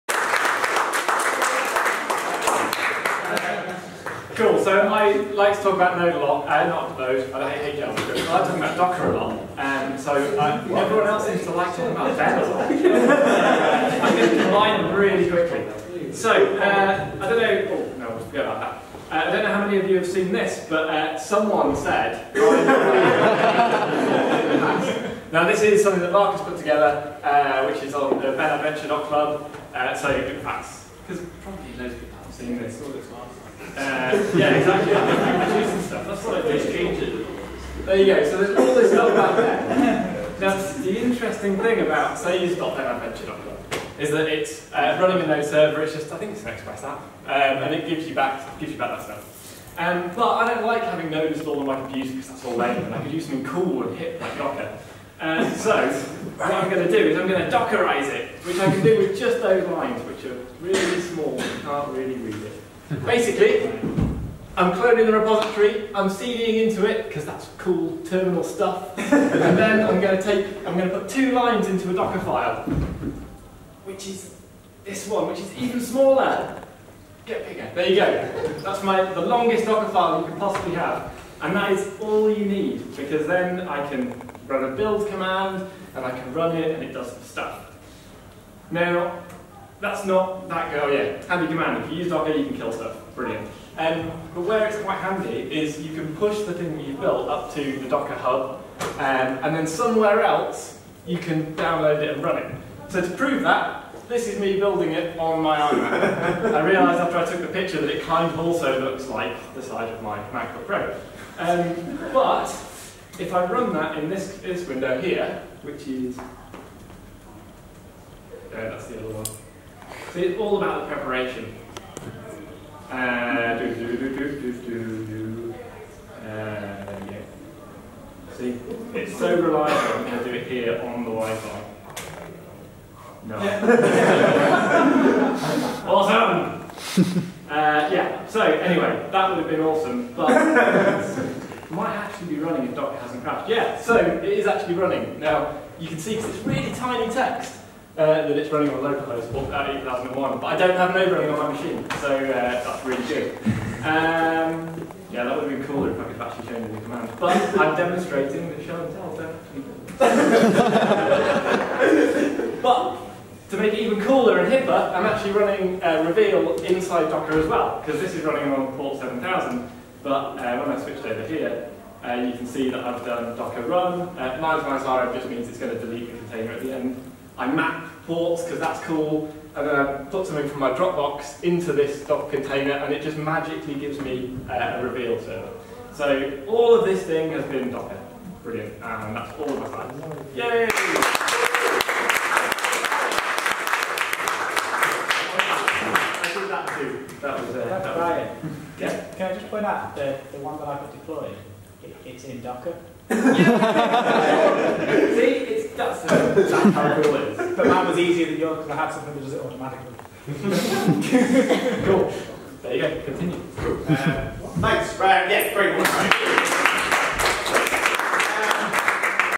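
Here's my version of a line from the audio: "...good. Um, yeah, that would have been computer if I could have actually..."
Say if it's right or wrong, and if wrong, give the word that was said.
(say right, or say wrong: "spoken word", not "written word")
wrong: "cooler", not "computer".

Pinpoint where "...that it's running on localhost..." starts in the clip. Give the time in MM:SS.
02:28.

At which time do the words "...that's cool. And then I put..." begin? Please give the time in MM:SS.
02:58.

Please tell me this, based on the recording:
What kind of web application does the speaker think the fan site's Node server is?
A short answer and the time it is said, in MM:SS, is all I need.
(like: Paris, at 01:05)
Express app, at 00:46.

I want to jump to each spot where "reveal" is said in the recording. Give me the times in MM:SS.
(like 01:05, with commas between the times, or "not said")
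02:46, 03:04.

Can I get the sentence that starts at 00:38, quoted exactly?
So there's all this stuff out there.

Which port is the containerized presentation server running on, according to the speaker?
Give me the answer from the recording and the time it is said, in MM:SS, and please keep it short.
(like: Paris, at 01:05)
7000, at 02:48.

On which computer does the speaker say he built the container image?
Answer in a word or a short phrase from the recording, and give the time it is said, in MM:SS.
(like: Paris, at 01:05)
iMac, at 01:45.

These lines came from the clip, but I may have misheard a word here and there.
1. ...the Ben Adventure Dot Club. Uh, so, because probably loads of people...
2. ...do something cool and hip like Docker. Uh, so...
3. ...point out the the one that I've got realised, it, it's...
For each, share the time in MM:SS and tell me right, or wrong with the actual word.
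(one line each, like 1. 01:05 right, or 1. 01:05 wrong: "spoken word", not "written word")
1. 00:28 right
2. 00:53 right
3. 03:19 wrong: "deployed", not "realised".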